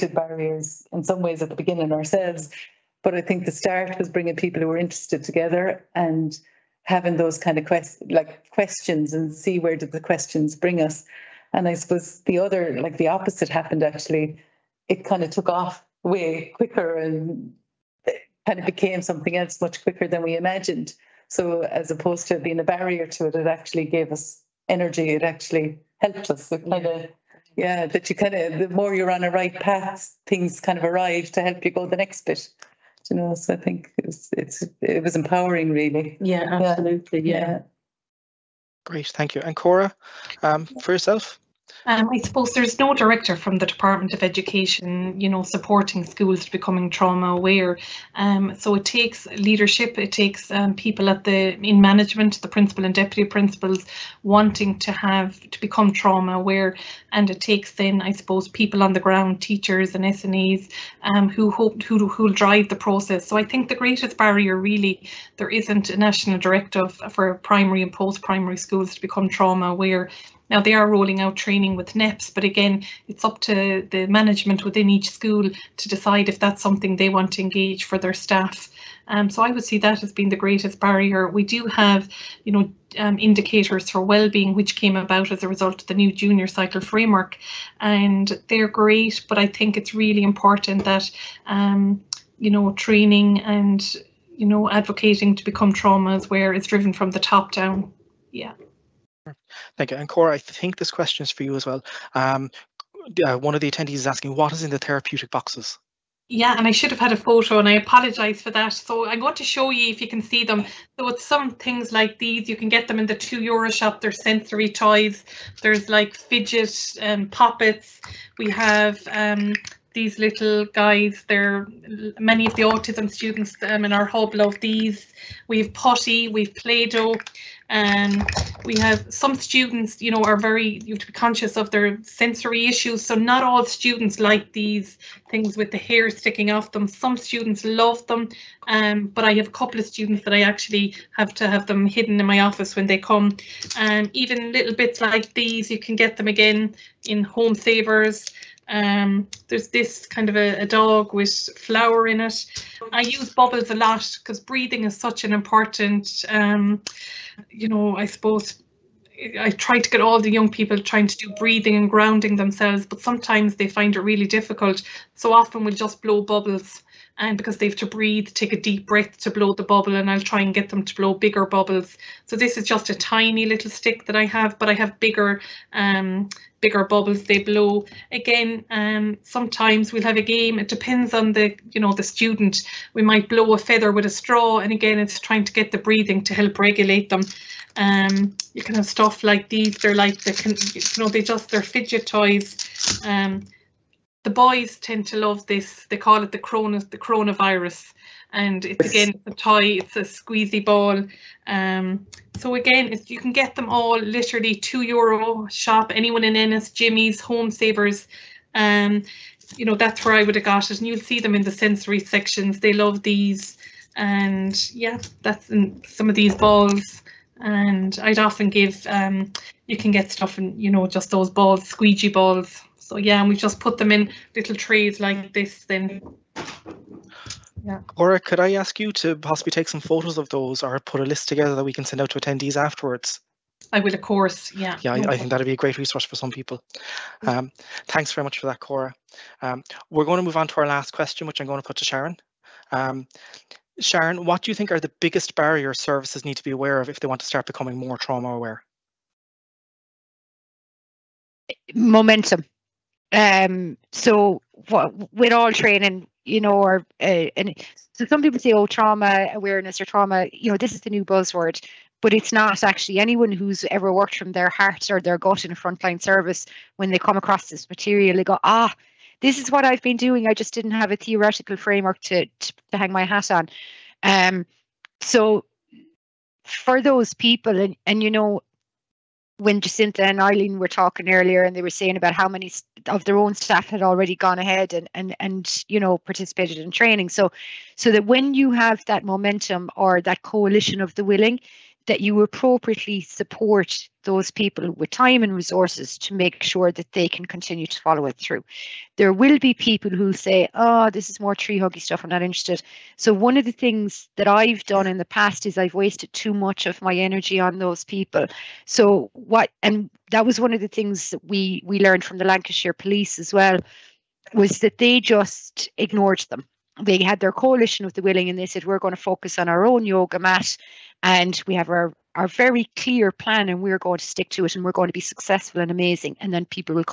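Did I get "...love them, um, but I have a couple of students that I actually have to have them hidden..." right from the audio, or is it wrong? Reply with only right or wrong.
right.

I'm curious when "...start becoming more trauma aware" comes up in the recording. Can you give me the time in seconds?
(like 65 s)
247 s.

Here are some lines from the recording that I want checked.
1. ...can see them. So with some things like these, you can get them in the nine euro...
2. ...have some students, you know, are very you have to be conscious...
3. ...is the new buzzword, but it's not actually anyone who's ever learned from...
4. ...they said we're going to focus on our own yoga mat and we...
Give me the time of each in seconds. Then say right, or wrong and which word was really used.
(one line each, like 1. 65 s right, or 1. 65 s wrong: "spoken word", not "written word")
1. 110 s wrong: "two", not "nine"
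2. 128 s right
3. 260 s wrong: "worked", not "learned"
4. 318 s right.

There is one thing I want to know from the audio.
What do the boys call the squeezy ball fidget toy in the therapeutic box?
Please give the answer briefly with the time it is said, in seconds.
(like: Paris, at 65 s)
The coronavirus, at 196 s.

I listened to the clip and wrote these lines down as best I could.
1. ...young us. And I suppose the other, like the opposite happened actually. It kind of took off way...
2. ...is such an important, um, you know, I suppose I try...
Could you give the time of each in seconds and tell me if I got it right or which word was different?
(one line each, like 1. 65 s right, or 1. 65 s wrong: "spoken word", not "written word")
1. 10 s wrong: "bring", not "young"
2. 154 s right.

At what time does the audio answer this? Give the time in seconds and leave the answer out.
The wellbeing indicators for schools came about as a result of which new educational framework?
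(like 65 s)
86 s.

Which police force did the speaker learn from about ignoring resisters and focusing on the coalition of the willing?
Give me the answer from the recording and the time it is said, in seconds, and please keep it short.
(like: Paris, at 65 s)
Lancashire police, at 312 s.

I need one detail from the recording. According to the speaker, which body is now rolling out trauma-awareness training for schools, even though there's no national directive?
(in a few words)
NEPS.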